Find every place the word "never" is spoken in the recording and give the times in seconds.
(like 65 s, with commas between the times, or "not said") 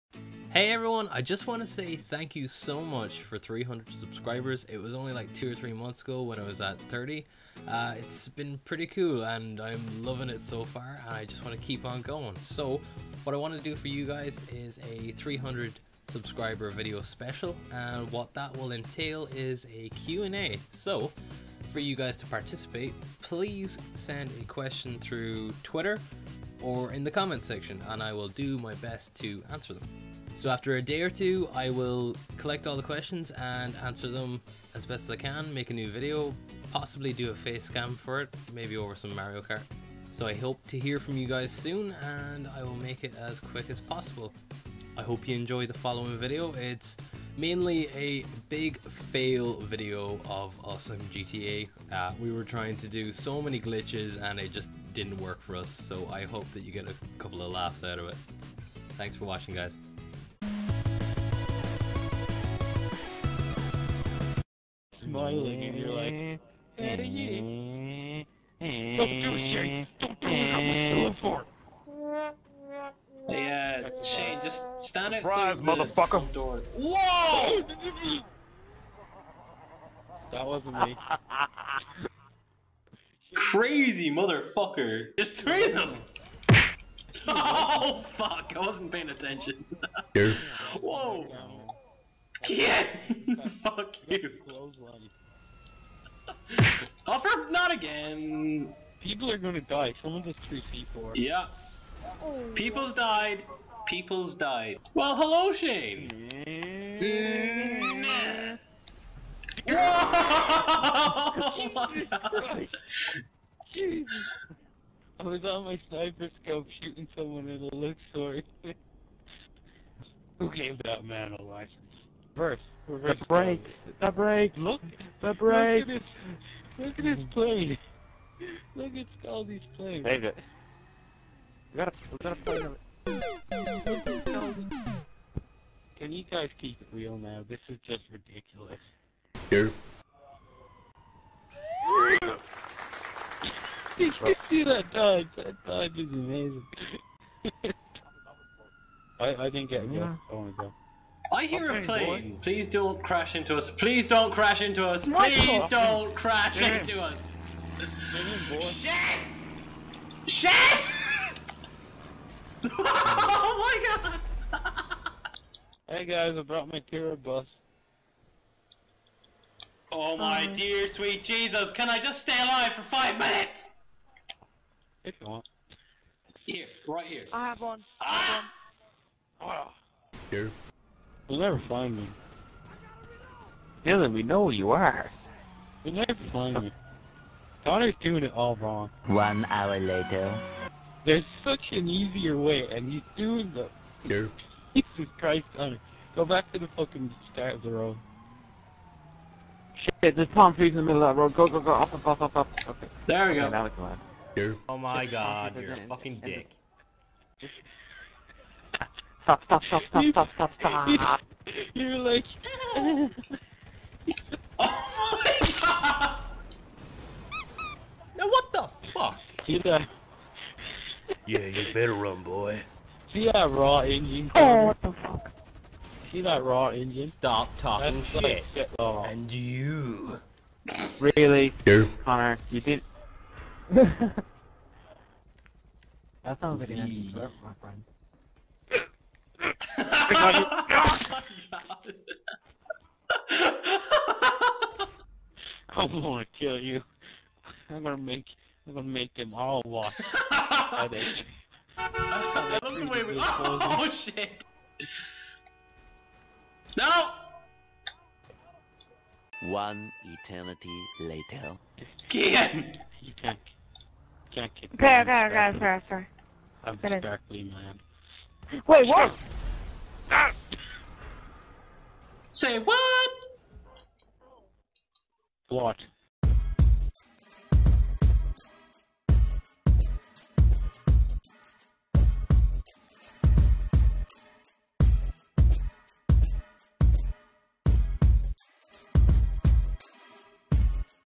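181 s, 186 s.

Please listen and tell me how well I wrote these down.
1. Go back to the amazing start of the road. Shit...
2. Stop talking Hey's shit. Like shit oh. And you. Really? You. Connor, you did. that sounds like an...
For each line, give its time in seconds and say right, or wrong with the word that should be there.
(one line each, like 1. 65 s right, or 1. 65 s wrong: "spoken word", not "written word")
1. 196 s wrong: "fucking", not "amazing"
2. 227 s wrong: "That", not "Hey".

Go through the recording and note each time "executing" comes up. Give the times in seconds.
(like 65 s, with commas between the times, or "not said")
not said.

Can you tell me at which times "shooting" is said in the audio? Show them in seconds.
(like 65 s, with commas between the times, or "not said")
116 s.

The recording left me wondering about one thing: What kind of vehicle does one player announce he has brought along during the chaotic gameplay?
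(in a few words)
Kira bus.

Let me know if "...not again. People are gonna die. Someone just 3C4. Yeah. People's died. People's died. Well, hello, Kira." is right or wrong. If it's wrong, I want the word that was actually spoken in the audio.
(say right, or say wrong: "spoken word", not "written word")
wrong: "Shane", not "Kira".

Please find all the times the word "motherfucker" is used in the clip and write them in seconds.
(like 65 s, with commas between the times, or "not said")
76 s, 84 s.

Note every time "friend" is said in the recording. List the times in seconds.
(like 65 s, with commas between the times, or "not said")
237 s.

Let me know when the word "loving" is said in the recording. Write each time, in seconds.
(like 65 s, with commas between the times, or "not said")
10 s.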